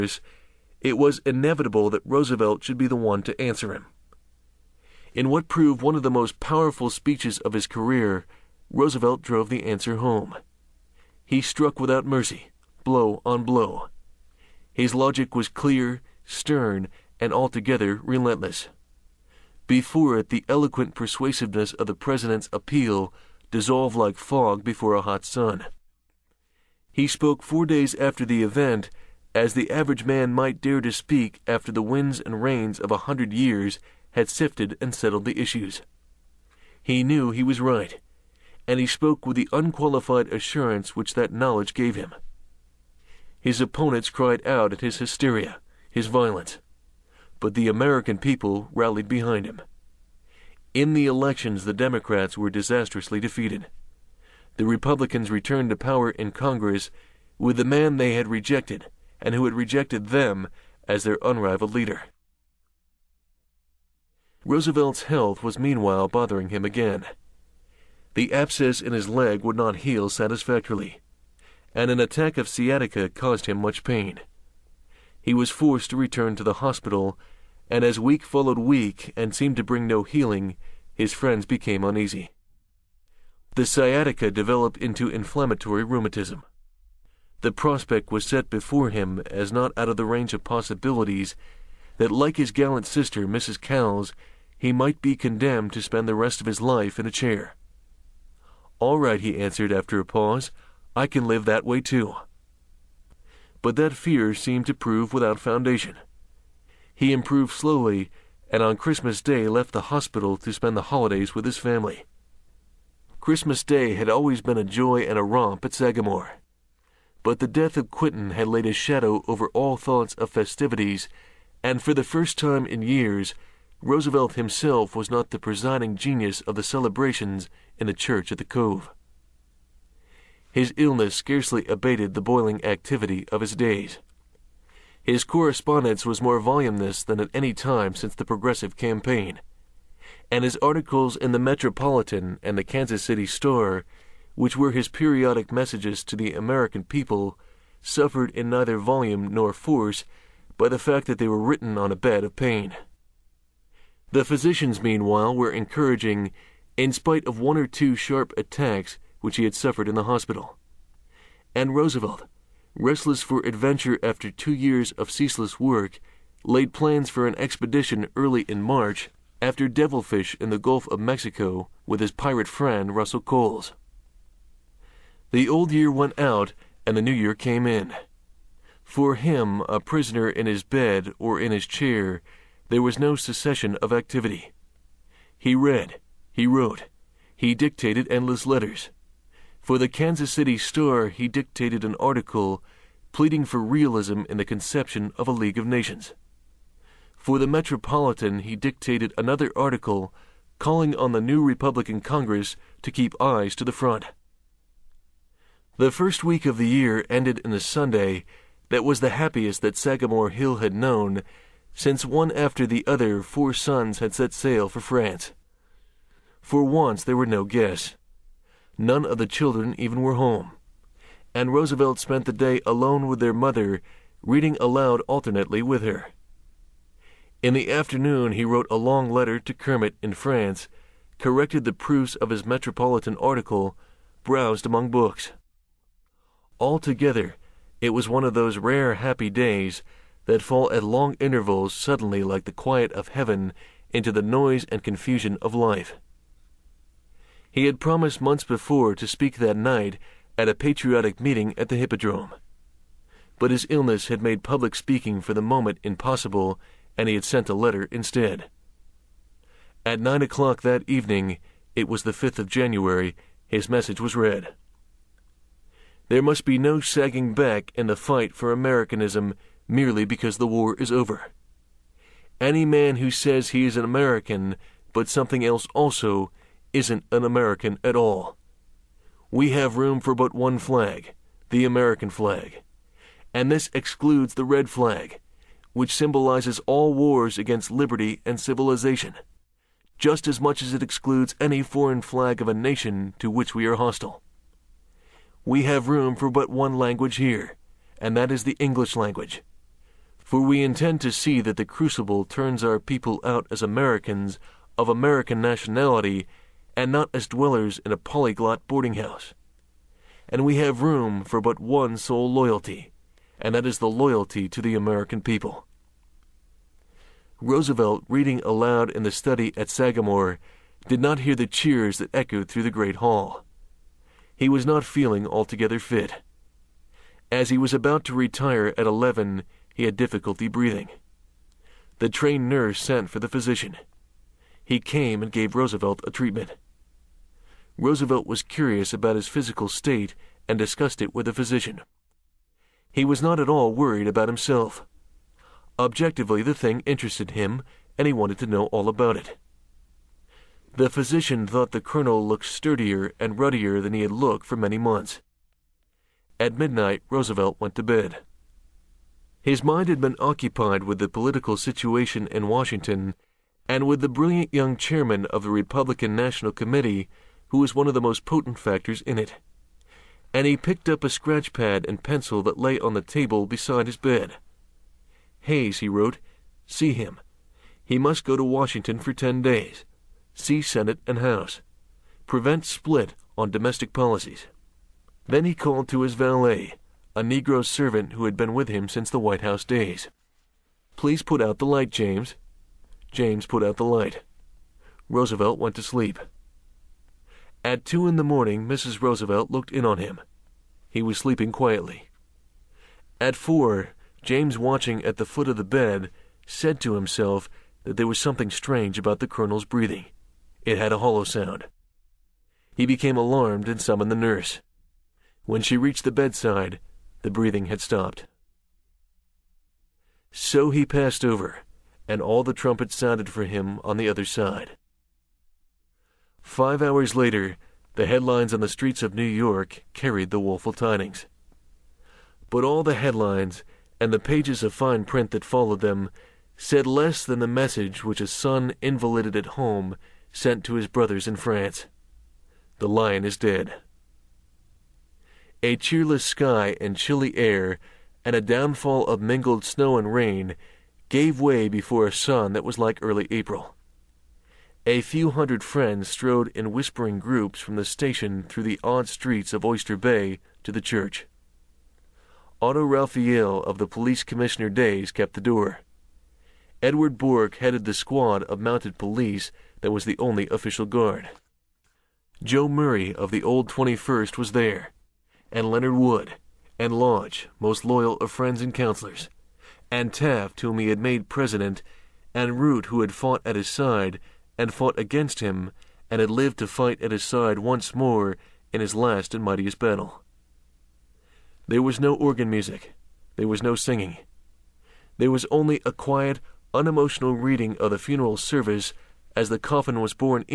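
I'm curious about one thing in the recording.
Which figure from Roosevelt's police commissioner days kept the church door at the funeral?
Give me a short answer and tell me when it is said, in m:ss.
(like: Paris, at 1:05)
Otto Raphael, at 7:42.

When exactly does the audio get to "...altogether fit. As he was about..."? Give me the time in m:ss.
5:25.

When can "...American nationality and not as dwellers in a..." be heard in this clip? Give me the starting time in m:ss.
5:04.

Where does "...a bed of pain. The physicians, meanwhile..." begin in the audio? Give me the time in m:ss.
2:31.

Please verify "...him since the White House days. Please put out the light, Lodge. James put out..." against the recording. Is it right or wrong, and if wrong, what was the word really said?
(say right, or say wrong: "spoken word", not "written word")
wrong: "James", not "Lodge".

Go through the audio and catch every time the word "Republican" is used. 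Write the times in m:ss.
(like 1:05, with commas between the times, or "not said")
0:54, 3:21, 6:05.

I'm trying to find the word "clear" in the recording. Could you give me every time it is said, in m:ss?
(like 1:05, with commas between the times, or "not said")
0:15.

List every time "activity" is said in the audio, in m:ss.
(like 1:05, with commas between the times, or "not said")
2:12, 3:03.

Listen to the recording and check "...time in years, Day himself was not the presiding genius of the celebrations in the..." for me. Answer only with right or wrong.
wrong.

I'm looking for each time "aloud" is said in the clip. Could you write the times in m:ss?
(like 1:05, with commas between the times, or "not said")
3:44, 5:18.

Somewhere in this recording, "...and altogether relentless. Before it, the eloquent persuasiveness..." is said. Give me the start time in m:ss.
0:17.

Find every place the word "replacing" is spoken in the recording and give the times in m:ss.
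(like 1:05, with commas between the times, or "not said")
not said.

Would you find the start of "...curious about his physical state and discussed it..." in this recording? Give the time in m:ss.
5:38.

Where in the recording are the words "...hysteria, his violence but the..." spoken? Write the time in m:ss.
0:44.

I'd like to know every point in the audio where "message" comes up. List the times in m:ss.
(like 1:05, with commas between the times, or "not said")
2:25, 4:23, 7:17.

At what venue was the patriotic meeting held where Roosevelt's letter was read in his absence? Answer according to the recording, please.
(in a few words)
the Hippodrome.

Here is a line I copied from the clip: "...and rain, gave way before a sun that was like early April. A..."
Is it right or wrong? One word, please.
right.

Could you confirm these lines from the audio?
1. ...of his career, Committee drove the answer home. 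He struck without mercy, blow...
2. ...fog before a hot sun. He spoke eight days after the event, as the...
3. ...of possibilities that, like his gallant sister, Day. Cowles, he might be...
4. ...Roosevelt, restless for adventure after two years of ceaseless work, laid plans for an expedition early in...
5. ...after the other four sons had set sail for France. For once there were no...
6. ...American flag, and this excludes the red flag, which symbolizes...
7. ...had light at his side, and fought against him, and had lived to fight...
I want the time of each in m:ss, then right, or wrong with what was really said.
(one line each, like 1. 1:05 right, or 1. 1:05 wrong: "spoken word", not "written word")
1. 0:07 wrong: "Roosevelt", not "Committee"
2. 0:24 wrong: "four", not "eight"
3. 1:30 wrong: "Mrs", not "Day"
4. 2:41 right
5. 3:32 right
6. 4:41 right
7. 8:03 wrong: "fought", not "light".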